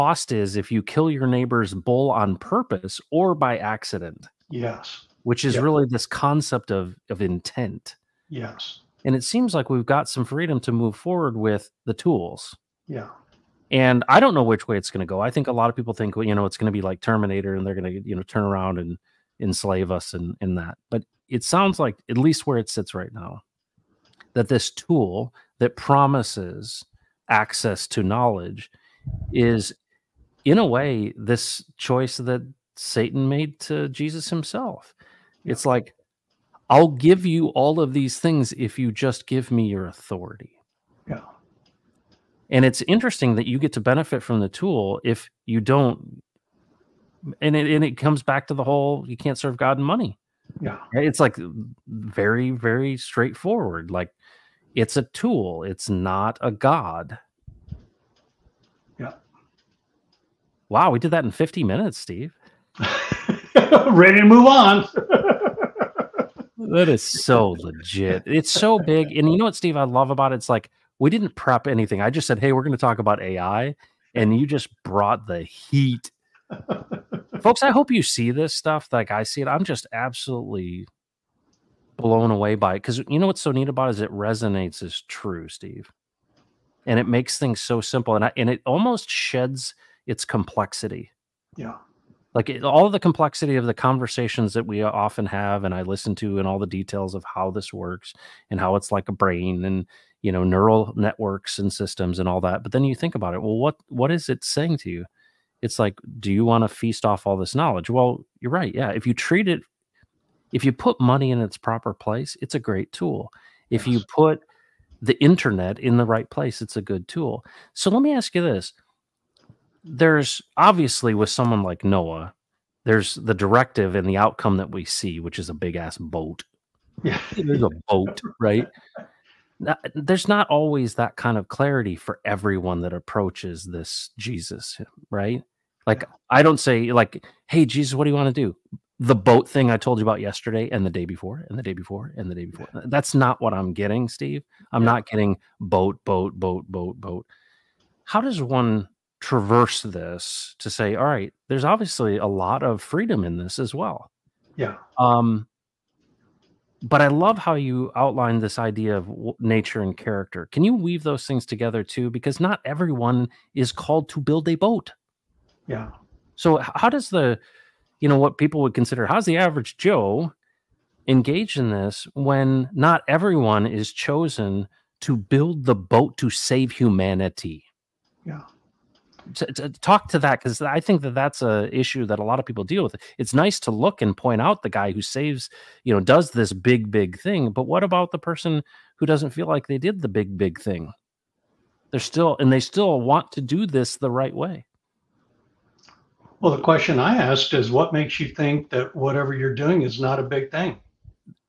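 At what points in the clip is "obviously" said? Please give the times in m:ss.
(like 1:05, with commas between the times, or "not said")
2:00, 2:31.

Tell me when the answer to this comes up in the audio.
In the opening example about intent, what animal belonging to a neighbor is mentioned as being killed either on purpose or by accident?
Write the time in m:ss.
0:01.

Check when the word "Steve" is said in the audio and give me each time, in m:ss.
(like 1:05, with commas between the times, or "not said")
1:01, 1:09, 1:25, 2:24.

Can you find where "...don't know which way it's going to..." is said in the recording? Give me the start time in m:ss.
0:14.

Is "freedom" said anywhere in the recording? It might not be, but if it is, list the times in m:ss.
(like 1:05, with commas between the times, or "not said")
0:10, 2:32.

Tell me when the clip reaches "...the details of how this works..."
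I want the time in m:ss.
1:36.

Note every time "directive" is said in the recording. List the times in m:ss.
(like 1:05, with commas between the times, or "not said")
2:03.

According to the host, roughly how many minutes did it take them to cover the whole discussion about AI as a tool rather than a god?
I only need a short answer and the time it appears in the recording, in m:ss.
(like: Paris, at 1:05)
50 minutes, at 1:01.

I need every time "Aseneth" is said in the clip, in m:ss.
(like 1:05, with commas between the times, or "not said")
not said.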